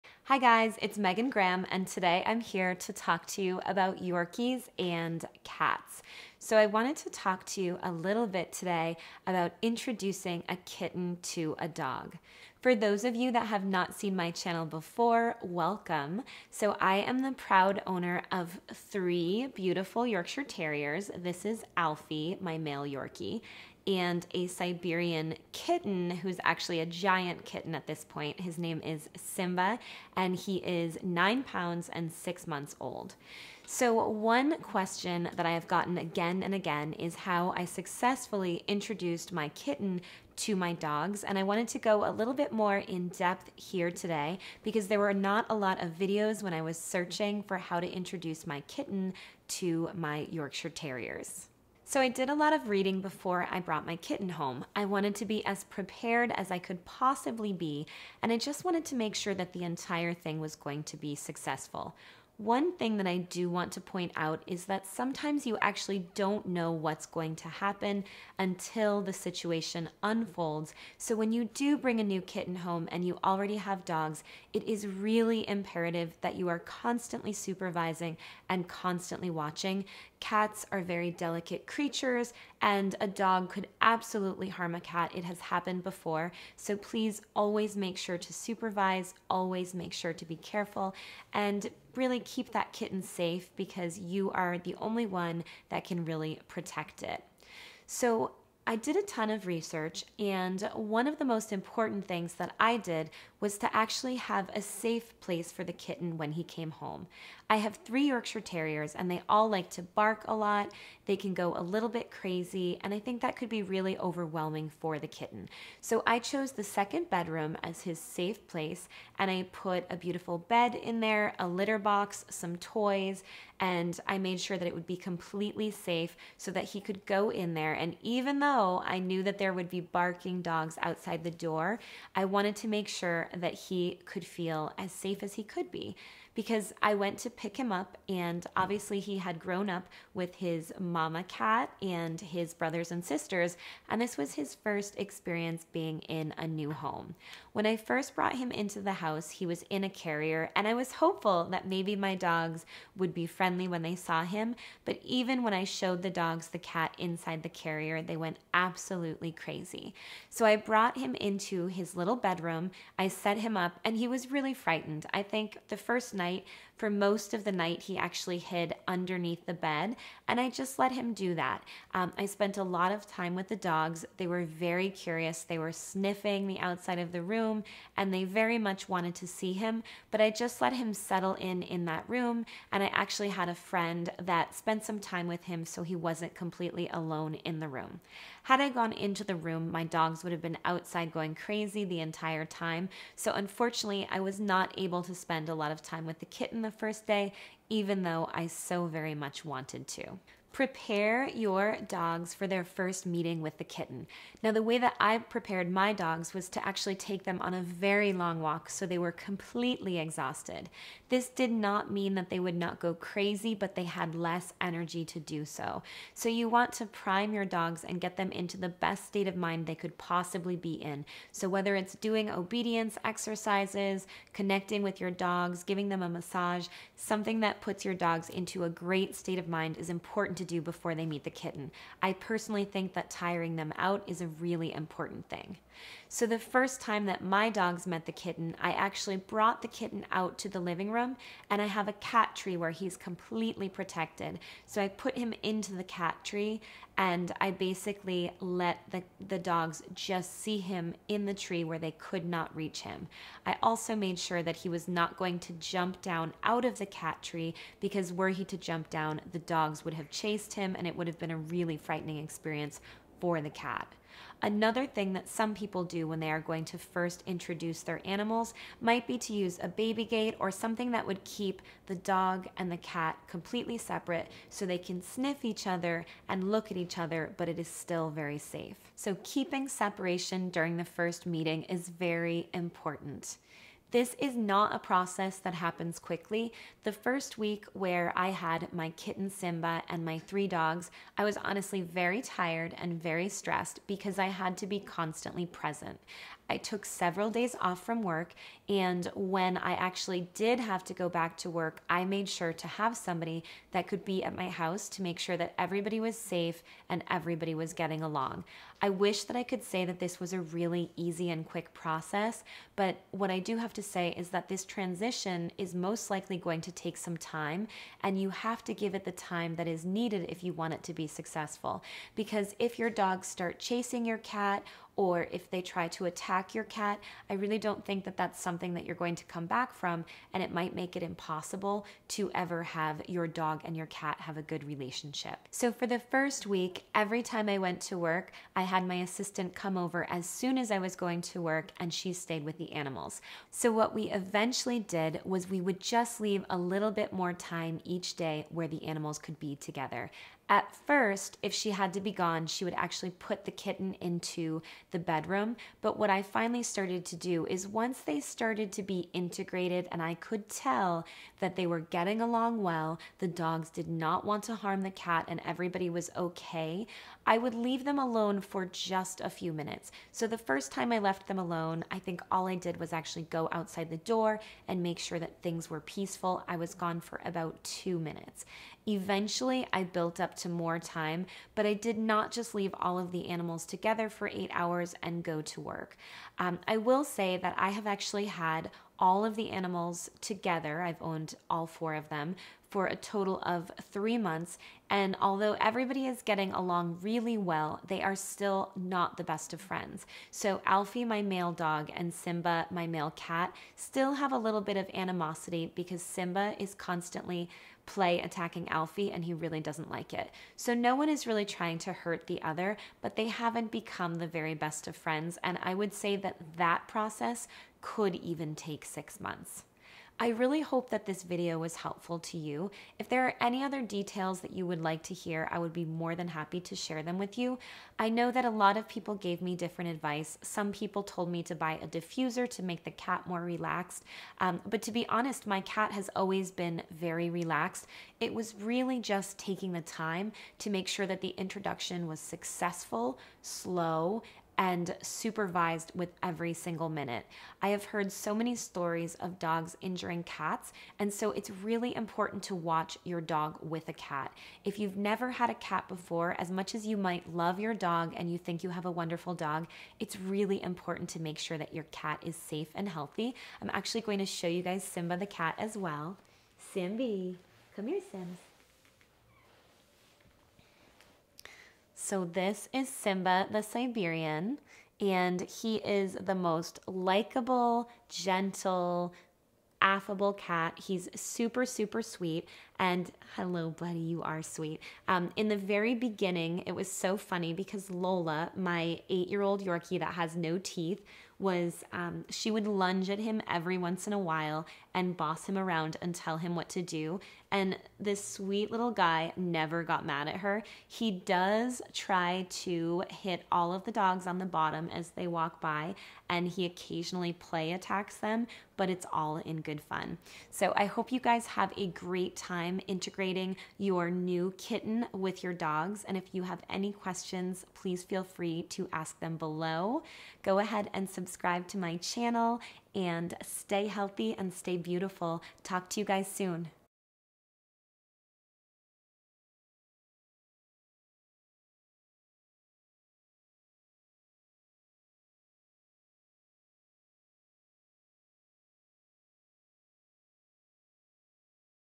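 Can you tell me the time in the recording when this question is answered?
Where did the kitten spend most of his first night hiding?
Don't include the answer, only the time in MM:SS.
02:48.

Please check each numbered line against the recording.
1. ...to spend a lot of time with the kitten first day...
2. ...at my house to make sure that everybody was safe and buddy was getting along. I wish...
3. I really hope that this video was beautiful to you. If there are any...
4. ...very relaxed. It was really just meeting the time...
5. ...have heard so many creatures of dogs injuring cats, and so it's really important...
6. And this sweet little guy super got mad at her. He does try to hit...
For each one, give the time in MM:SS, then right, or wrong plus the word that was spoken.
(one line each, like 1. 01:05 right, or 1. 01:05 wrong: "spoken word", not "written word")
1. 03:15 right
2. 05:04 wrong: "everybody", not "buddy"
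3. 07:00 wrong: "helpful", not "beautiful"
4. 07:16 wrong: "taking", not "meeting"
5. 07:27 wrong: "stories", not "creatures"
6. 08:17 wrong: "never", not "super".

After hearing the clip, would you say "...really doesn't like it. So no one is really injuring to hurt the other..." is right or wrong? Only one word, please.
wrong.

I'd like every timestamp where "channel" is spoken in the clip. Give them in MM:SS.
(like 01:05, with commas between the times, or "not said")
00:14, 08:41.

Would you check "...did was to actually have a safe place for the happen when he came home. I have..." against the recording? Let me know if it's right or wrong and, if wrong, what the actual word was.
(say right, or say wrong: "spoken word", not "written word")
wrong: "kitten", not "happen".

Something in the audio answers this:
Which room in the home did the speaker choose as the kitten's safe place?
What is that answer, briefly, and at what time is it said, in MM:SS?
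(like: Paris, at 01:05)
Second bedroom, at 01:56.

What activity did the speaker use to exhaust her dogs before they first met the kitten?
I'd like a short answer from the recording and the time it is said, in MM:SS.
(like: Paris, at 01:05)
A very long walk, at 03:27.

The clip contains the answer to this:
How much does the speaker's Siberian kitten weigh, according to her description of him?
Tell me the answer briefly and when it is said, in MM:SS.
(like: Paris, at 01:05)
9 pounds, at 00:31.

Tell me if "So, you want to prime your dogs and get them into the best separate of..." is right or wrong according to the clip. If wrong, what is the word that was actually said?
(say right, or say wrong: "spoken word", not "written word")
wrong: "state", not "separate".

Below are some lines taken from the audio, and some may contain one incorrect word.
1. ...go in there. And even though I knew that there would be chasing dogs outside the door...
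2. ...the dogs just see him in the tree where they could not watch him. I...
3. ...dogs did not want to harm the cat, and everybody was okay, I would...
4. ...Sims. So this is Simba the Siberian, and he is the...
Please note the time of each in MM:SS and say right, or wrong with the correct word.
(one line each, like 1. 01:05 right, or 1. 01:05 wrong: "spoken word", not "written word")
1. 02:07 wrong: "barking", not "chasing"
2. 04:09 wrong: "reach", not "watch"
3. 06:03 right
4. 07:48 right.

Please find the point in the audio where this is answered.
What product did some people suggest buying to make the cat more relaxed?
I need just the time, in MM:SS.
07:11.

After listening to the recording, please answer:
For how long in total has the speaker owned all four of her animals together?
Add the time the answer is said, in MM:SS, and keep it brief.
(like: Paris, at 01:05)
3 months, at 06:33.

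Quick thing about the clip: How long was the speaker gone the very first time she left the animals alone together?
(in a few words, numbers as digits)
About 2 minutes.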